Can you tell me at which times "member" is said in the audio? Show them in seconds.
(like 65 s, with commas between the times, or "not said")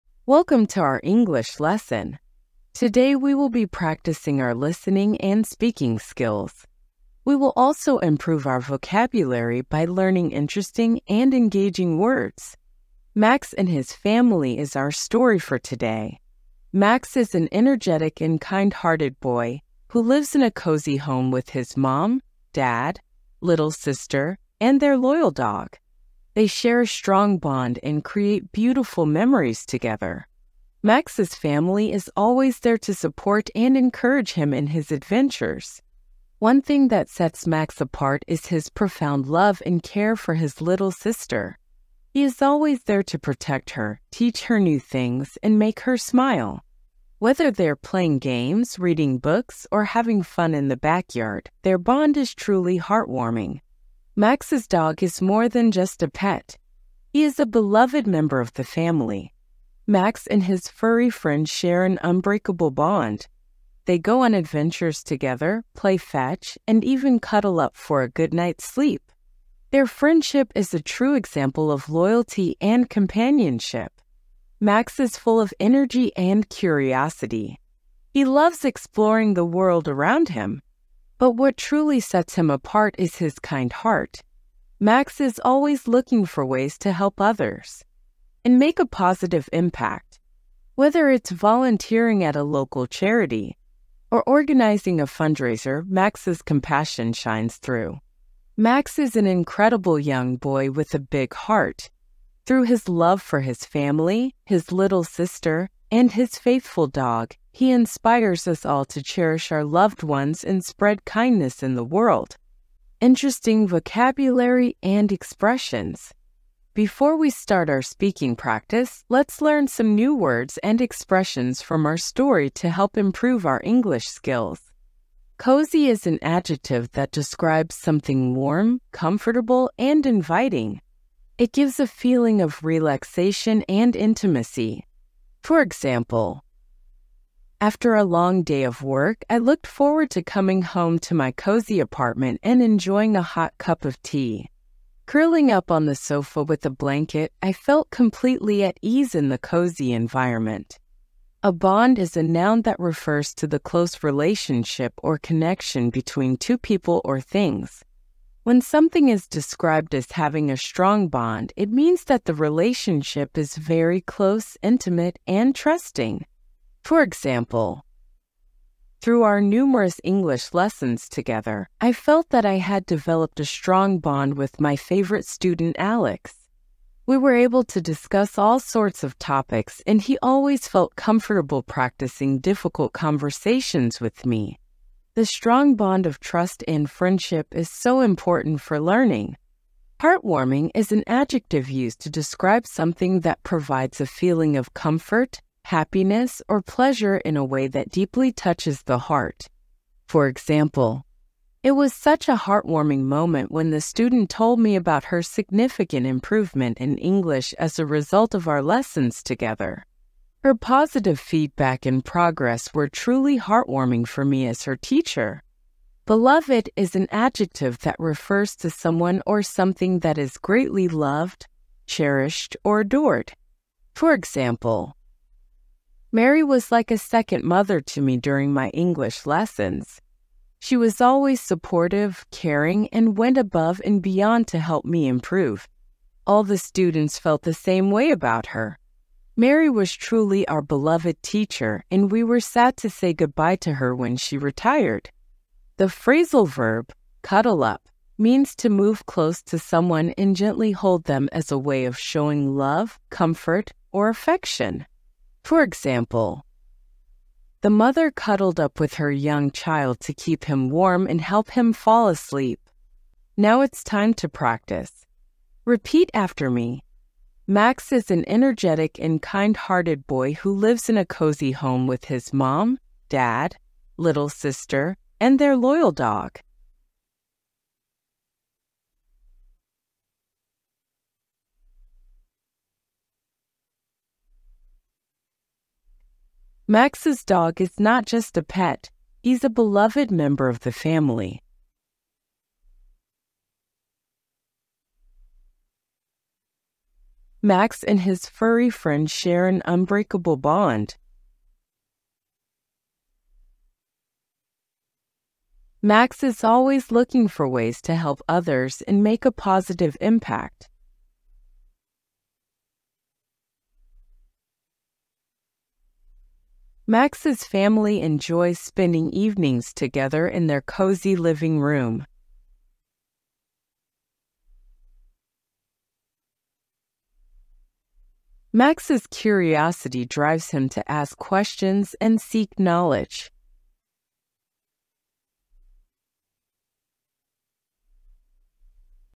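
58 s, 290 s.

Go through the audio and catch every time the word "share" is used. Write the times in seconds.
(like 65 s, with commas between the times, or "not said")
26 s, 61 s, 299 s.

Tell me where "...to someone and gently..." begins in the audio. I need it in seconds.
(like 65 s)
249 s.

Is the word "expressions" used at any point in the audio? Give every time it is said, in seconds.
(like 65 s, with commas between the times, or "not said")
115 s, 120 s.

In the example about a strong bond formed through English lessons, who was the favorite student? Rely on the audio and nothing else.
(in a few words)
Alex.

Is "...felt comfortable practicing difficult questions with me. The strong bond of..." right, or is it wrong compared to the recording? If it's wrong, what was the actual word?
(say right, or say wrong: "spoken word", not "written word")
wrong: "conversations", not "questions".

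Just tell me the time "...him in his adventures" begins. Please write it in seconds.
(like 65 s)
34 s.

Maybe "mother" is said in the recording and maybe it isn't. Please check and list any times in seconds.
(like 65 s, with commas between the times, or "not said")
227 s, 257 s.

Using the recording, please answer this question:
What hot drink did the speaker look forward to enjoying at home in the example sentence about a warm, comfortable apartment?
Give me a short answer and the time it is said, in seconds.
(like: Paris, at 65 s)
tea, at 144 s.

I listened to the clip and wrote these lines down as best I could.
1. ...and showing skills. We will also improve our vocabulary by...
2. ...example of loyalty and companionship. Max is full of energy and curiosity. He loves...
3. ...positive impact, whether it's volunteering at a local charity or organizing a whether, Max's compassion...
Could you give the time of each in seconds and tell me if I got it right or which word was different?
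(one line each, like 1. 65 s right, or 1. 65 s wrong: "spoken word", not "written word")
1. 5 s wrong: "speaking", not "showing"
2. 71 s right
3. 88 s wrong: "fundraiser", not "whether".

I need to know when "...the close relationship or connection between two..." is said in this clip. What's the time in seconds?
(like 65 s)
153 s.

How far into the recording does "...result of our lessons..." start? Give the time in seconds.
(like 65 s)
207 s.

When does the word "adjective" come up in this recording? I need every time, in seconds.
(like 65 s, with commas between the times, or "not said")
126 s, 191 s, 217 s.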